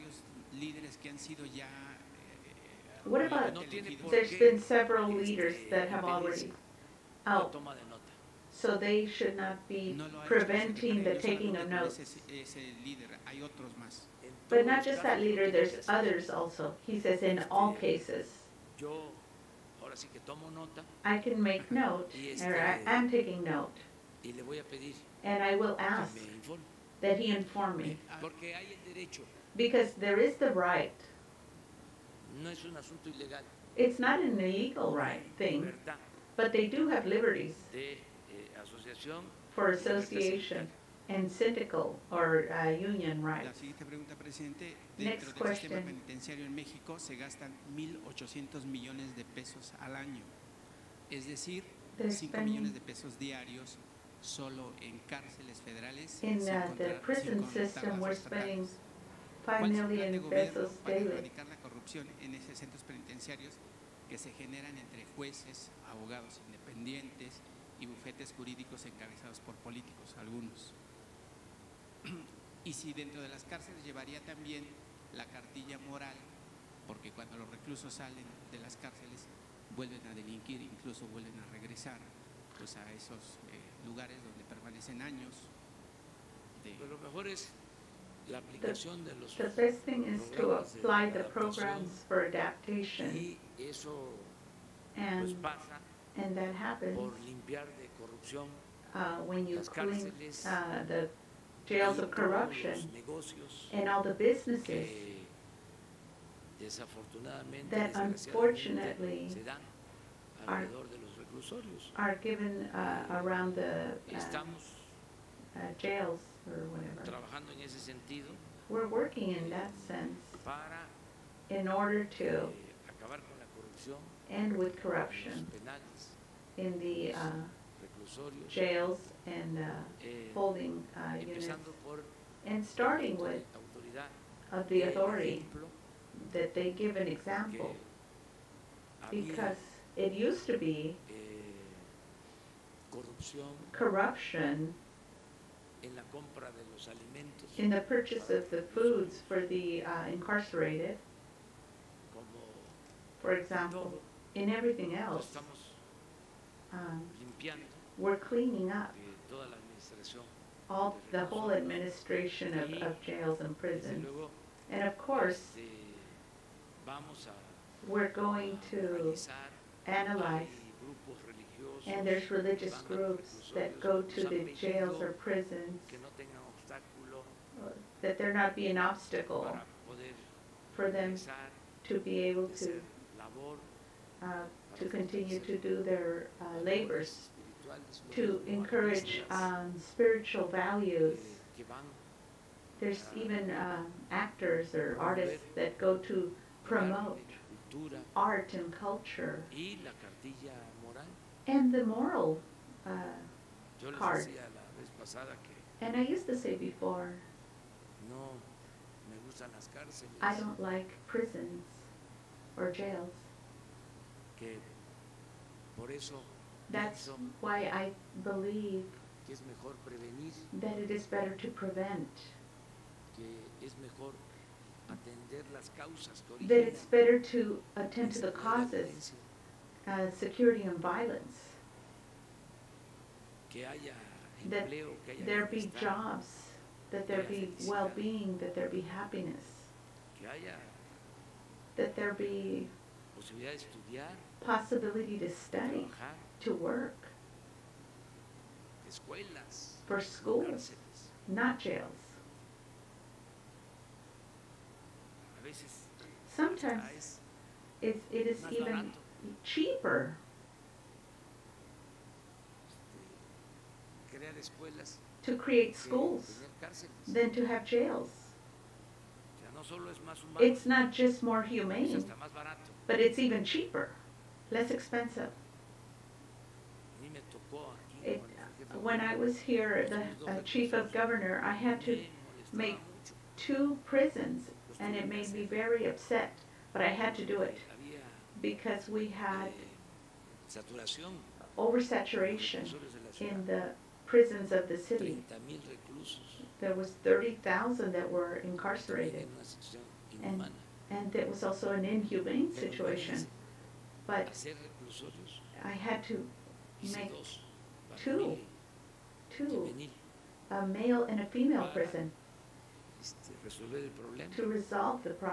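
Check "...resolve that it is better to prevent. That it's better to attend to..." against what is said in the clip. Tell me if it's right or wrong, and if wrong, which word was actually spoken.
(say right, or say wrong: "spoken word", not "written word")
wrong: "believe", not "resolve".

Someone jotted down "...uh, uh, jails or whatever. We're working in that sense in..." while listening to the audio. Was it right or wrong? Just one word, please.
right.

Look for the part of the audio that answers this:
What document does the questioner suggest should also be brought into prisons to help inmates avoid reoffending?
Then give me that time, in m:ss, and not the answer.
1:15.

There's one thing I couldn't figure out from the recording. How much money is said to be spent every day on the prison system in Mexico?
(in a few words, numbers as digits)
5 million pesos.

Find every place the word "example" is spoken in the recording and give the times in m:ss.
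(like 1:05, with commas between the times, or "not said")
2:17, 2:33.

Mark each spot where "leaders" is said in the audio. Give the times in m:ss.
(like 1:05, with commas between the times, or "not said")
0:05, 0:15.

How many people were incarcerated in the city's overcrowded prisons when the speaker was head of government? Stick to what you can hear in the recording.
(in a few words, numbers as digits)
30,000.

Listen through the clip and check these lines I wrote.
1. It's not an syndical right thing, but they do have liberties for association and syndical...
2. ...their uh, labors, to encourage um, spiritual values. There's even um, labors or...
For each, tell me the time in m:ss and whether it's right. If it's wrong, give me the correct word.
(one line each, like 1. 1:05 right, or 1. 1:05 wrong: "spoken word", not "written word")
1. 0:33 wrong: "illegal", not "syndical"
2. 3:05 wrong: "actors", not "labors".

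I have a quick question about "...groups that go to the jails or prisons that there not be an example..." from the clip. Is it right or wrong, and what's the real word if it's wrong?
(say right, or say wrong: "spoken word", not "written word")
wrong: "obstacle", not "example".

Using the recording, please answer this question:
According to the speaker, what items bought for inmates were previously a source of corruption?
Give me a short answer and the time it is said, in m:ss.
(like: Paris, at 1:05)
foods, at 2:28.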